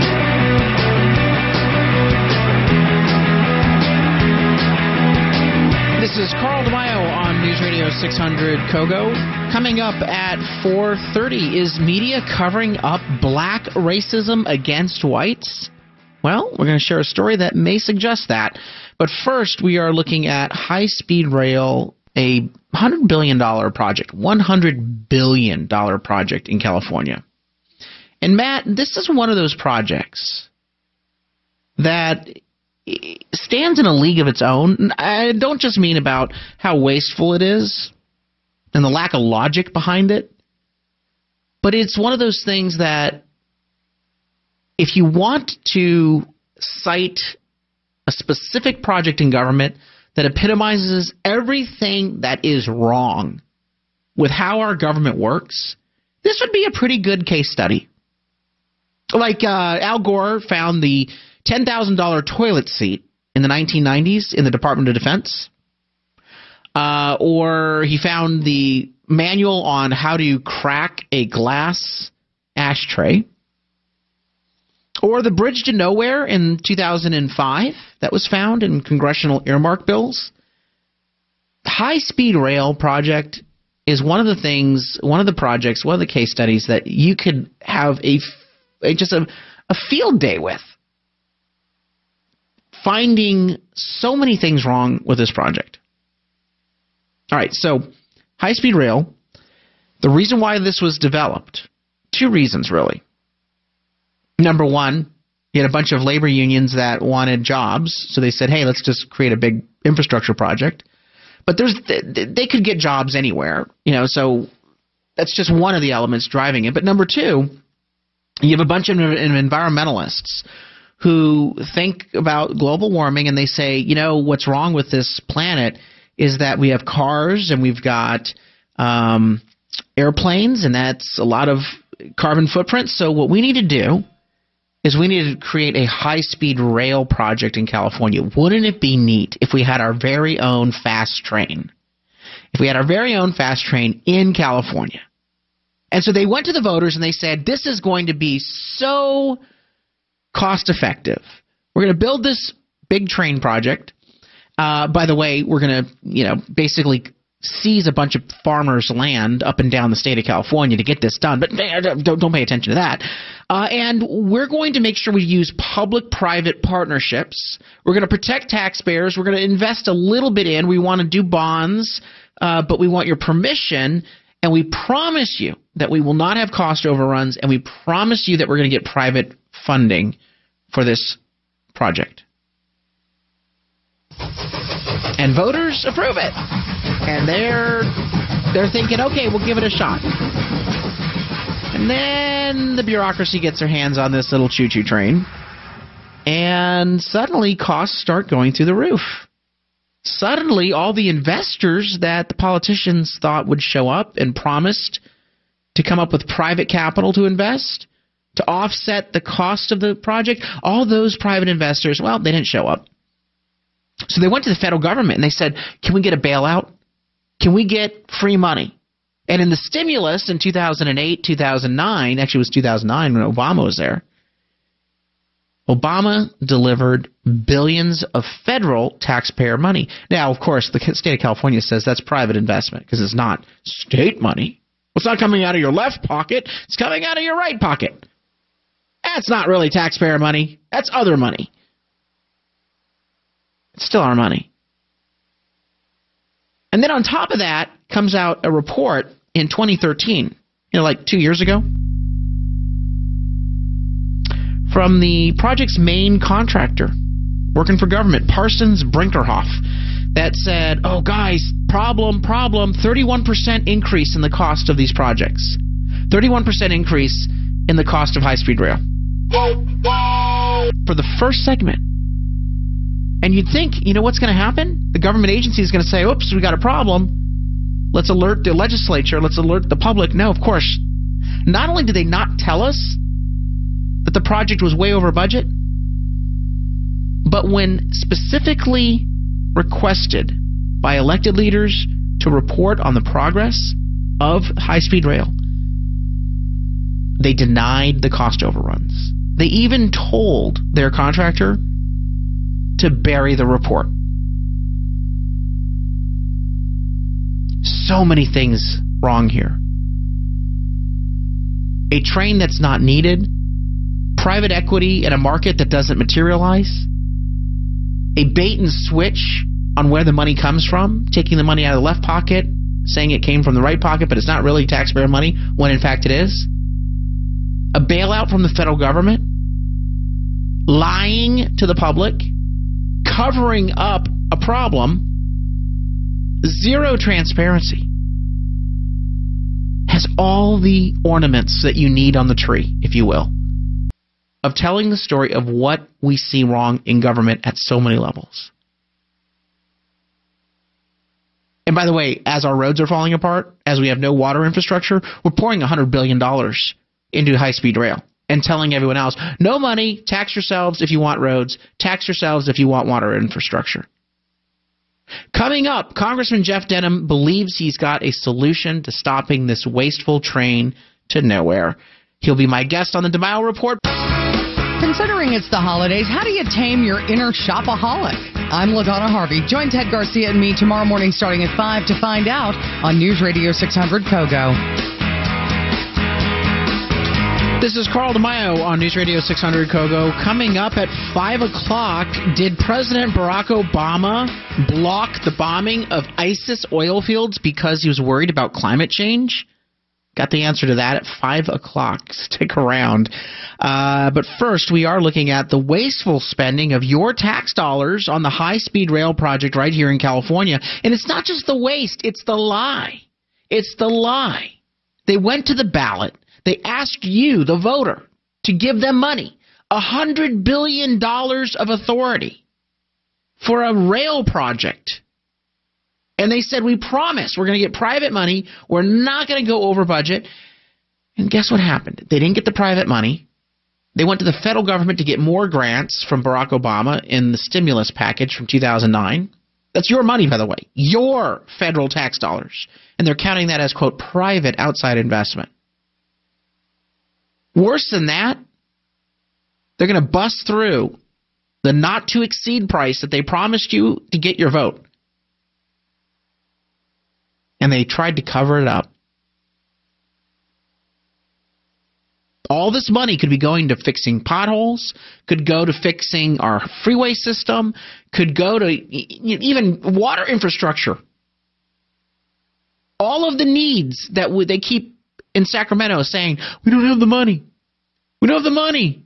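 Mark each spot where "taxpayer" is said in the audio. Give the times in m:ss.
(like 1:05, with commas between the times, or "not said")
2:48, 3:48, 3:59, 5:24.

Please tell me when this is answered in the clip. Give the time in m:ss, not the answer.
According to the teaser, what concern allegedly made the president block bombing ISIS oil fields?
6:38.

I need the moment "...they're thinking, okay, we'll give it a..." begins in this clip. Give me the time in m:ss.
3:08.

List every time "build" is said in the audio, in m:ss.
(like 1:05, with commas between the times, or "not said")
2:31.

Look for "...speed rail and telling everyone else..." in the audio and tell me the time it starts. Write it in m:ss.
5:57.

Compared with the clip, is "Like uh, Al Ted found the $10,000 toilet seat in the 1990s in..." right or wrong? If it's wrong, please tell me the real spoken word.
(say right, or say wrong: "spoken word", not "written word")
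wrong: "Gore", not "Ted".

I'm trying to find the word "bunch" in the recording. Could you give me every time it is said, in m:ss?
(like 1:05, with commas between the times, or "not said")
1:45, 1:58, 2:37.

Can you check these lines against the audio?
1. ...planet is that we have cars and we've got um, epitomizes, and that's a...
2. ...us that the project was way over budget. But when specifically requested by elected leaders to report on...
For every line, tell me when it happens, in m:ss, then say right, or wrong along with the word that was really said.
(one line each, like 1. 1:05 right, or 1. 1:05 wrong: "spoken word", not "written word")
1. 2:05 wrong: "airplanes", not "epitomizes"
2. 4:42 right.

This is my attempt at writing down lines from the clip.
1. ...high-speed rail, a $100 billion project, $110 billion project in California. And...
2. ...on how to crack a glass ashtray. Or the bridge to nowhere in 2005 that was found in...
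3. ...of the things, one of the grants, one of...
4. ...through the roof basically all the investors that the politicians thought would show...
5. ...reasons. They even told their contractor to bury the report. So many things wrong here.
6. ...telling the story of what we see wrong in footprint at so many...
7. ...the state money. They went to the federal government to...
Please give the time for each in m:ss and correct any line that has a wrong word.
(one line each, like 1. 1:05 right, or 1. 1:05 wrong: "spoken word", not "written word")
1. 0:20 wrong: "100", not "110"
2. 1:09 right
3. 1:24 wrong: "projects", not "grants"
4. 3:18 wrong: "suddenly", not "basically"
5. 4:58 wrong: "overruns", not "reasons"
6. 5:44 wrong: "government", not "footprint"
7. 7:12 wrong: "private", not "state".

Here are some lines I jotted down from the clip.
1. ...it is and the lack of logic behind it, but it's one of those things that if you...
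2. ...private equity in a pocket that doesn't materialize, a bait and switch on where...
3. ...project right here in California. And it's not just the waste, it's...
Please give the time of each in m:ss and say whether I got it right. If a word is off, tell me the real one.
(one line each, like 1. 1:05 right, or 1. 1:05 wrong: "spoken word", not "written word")
1. 0:37 right
2. 5:14 wrong: "market", not "pocket"
3. 6:49 right.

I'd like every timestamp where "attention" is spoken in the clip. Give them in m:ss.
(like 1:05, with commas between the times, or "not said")
2:42.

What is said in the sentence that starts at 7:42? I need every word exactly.
All this money could be going to fixing potholes, could go to fixing our freeway system, could go to even water infrastructure.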